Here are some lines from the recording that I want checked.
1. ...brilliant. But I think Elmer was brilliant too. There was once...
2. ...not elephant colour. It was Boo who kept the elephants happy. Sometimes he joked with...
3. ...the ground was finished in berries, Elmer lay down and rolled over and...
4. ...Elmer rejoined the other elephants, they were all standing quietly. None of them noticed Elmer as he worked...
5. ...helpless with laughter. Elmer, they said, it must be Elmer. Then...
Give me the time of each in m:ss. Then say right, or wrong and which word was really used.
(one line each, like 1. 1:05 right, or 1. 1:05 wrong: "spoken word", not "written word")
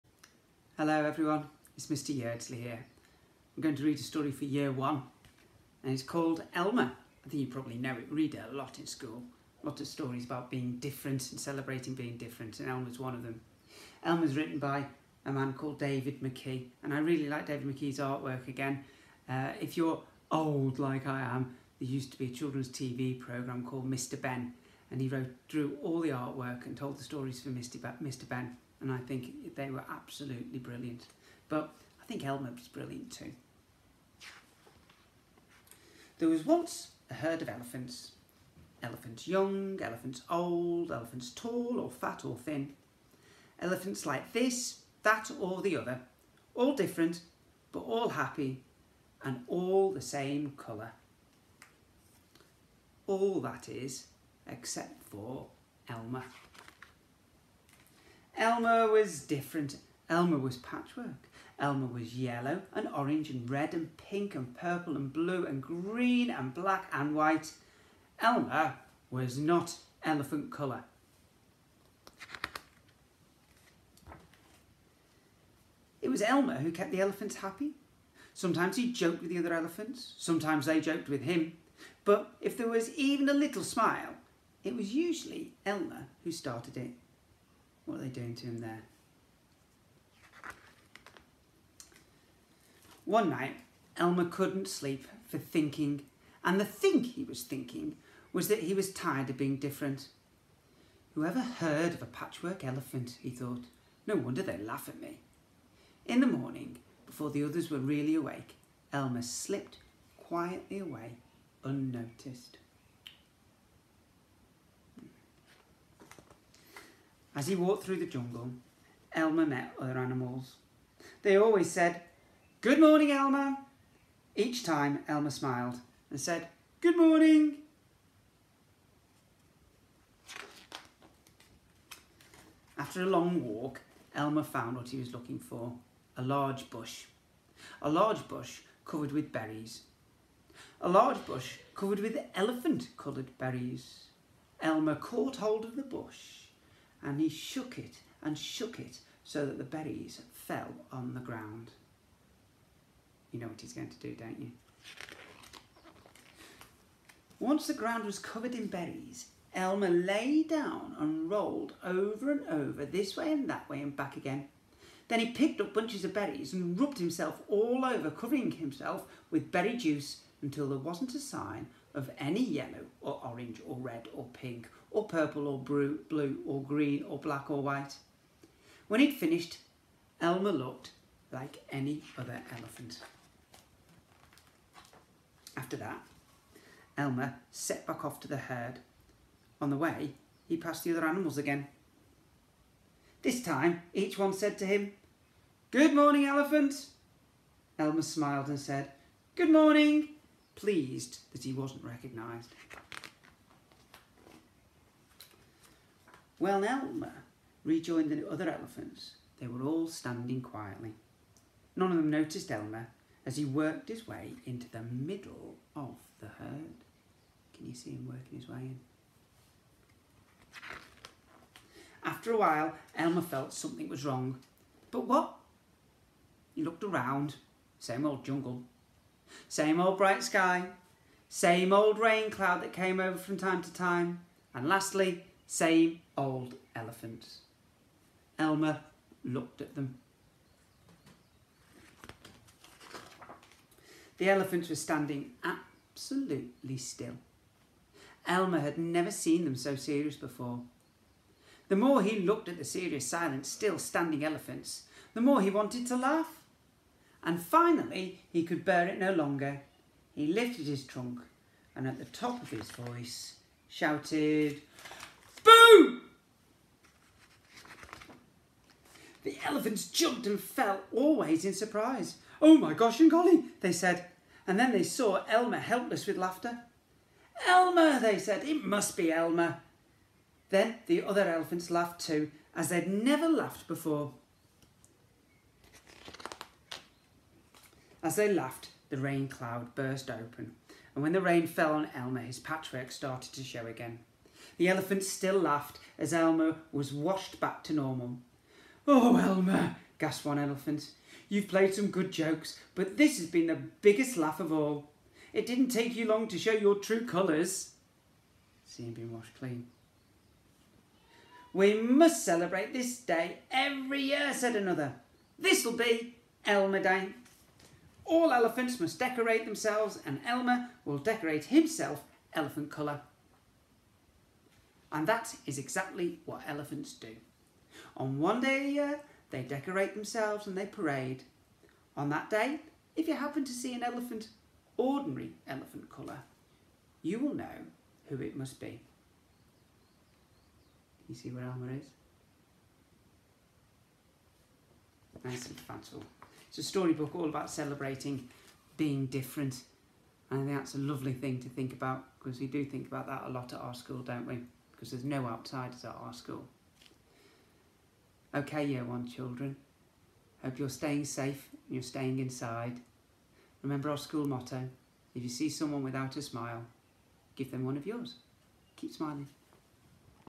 1. 0:30 right
2. 1:09 wrong: "Elmer", not "Boo"
3. 2:37 wrong: "covered", not "finished"
4. 3:26 right
5. 4:35 right.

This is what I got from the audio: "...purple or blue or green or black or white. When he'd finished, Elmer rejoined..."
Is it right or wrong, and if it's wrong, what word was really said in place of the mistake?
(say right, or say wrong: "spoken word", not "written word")
wrong: "looked", not "rejoined".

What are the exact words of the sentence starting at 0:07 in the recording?
I think you probably know it, read it a lot in school.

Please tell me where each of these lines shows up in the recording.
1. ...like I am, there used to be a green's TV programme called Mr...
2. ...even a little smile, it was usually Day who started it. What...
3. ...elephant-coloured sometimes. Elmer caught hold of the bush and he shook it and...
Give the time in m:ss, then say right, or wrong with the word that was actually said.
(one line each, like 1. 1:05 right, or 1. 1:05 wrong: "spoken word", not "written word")
1. 0:20 wrong: "children", not "green"
2. 1:22 wrong: "Elmer", not "Day"
3. 2:22 wrong: "berries", not "sometimes".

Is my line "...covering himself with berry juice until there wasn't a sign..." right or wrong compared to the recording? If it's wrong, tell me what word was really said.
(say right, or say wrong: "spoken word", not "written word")
right.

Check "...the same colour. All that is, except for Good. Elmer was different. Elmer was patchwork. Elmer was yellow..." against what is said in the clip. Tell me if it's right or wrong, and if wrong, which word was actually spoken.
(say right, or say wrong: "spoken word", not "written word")
wrong: "Elmer", not "Good".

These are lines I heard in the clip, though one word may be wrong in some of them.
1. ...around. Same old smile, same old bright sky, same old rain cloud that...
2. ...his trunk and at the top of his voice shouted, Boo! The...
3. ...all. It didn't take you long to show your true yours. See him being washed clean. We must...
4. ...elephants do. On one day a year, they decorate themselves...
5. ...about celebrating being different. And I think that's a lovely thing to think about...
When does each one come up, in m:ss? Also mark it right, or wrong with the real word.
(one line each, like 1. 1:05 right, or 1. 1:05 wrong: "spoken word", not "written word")
1. 3:46 wrong: "jungle", not "smile"
2. 4:20 right
3. 5:04 wrong: "colours", not "yours"
4. 5:26 right
5. 5:47 right.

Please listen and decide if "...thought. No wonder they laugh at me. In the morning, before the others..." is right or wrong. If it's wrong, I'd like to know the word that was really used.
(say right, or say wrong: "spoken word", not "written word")
right.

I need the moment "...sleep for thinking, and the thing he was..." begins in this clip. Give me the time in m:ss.
1:34.